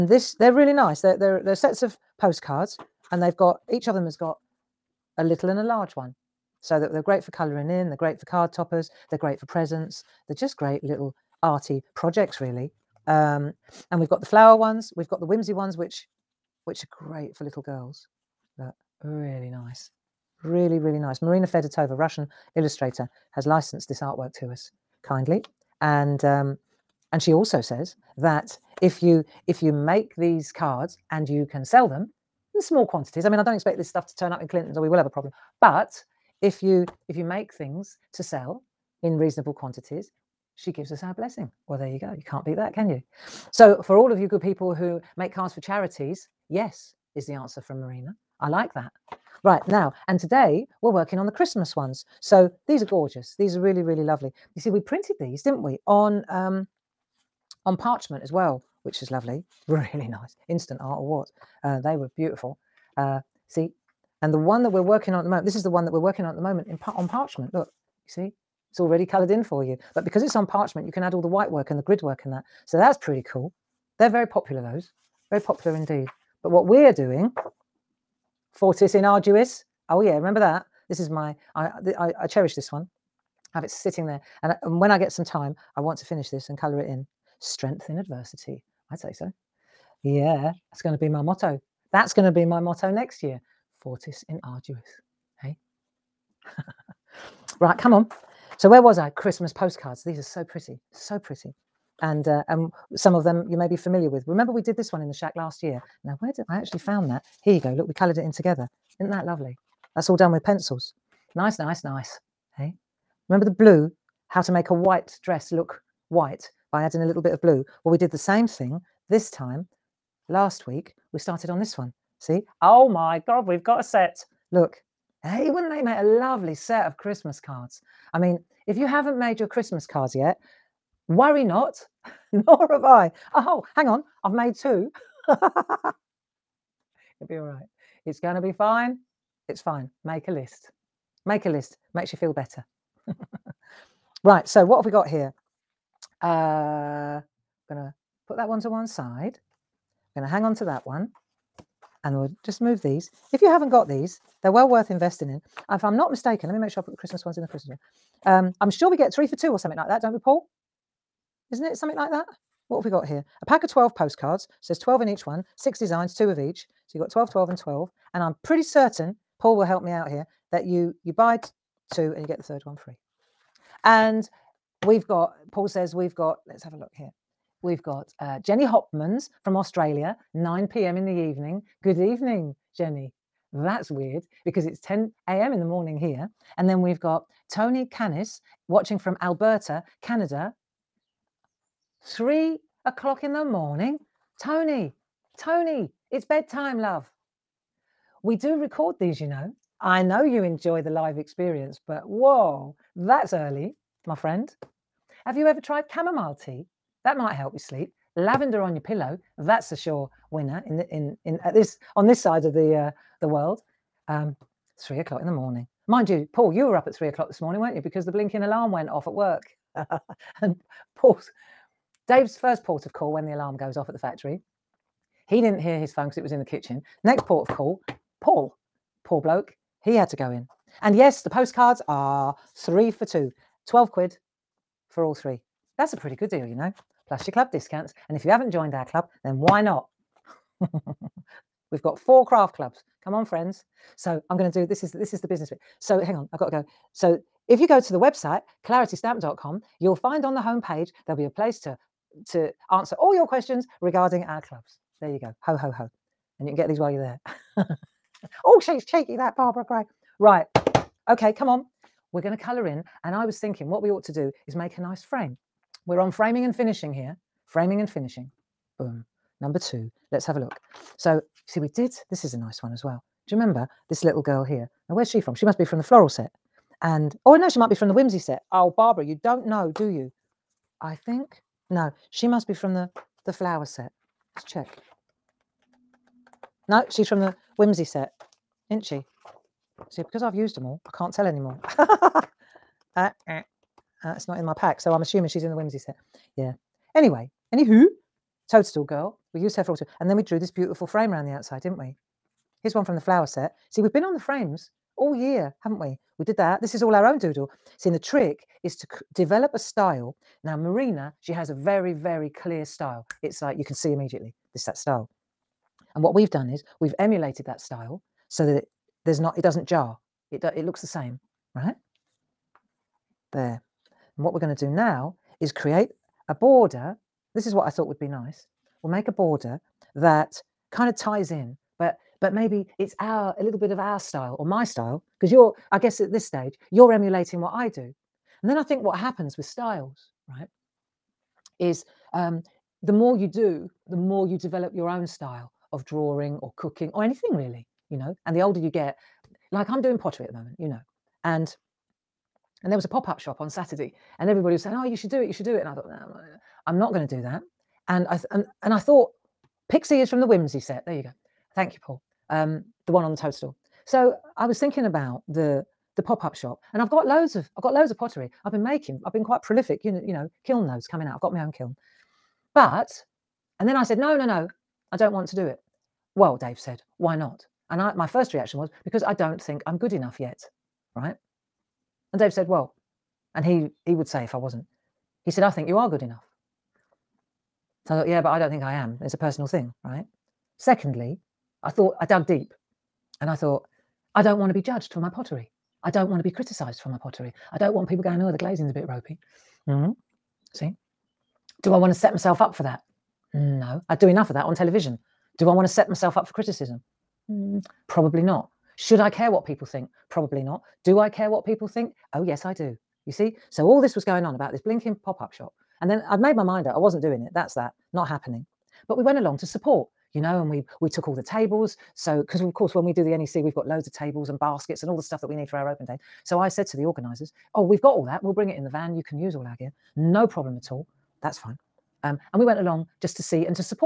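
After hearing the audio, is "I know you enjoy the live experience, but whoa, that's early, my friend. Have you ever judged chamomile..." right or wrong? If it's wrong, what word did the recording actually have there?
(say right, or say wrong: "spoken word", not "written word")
wrong: "tried", not "judged".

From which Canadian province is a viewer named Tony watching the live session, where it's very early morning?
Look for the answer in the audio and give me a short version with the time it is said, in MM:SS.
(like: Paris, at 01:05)
Alberta, at 03:09.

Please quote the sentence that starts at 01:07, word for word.
Look, you see, it's already colored in for you.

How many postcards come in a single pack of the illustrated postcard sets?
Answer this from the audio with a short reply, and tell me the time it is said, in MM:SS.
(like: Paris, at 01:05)
12, at 02:43.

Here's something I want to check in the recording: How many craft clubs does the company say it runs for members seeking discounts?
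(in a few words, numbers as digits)
4.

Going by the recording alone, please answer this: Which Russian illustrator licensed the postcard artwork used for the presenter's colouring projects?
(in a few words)
Marina Fedotova.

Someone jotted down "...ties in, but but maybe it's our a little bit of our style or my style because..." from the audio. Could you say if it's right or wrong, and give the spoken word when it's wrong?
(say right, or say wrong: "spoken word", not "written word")
right.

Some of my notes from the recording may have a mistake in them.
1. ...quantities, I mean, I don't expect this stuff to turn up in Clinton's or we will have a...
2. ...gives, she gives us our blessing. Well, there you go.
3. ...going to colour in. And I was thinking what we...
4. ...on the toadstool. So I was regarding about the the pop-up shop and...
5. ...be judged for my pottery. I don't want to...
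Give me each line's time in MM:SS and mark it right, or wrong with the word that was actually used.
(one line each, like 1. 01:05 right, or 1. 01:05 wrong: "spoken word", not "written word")
1. 00:32 right
2. 00:39 wrong: "quantities", not "gives"
3. 04:22 right
4. 06:03 wrong: "thinking", not "regarding"
5. 06:34 right.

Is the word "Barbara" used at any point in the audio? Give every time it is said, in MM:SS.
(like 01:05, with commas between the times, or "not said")
04:19, 04:38.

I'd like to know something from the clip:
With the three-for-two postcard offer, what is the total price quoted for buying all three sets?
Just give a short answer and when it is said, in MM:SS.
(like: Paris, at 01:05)
12 quid, at 03:53.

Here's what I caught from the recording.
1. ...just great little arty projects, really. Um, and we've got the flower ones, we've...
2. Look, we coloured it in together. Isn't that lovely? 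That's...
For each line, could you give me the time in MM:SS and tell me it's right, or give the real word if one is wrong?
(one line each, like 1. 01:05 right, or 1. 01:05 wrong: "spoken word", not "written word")
1. 00:10 right
2. 01:47 right.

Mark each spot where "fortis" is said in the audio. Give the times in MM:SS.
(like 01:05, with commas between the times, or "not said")
01:18, 01:33.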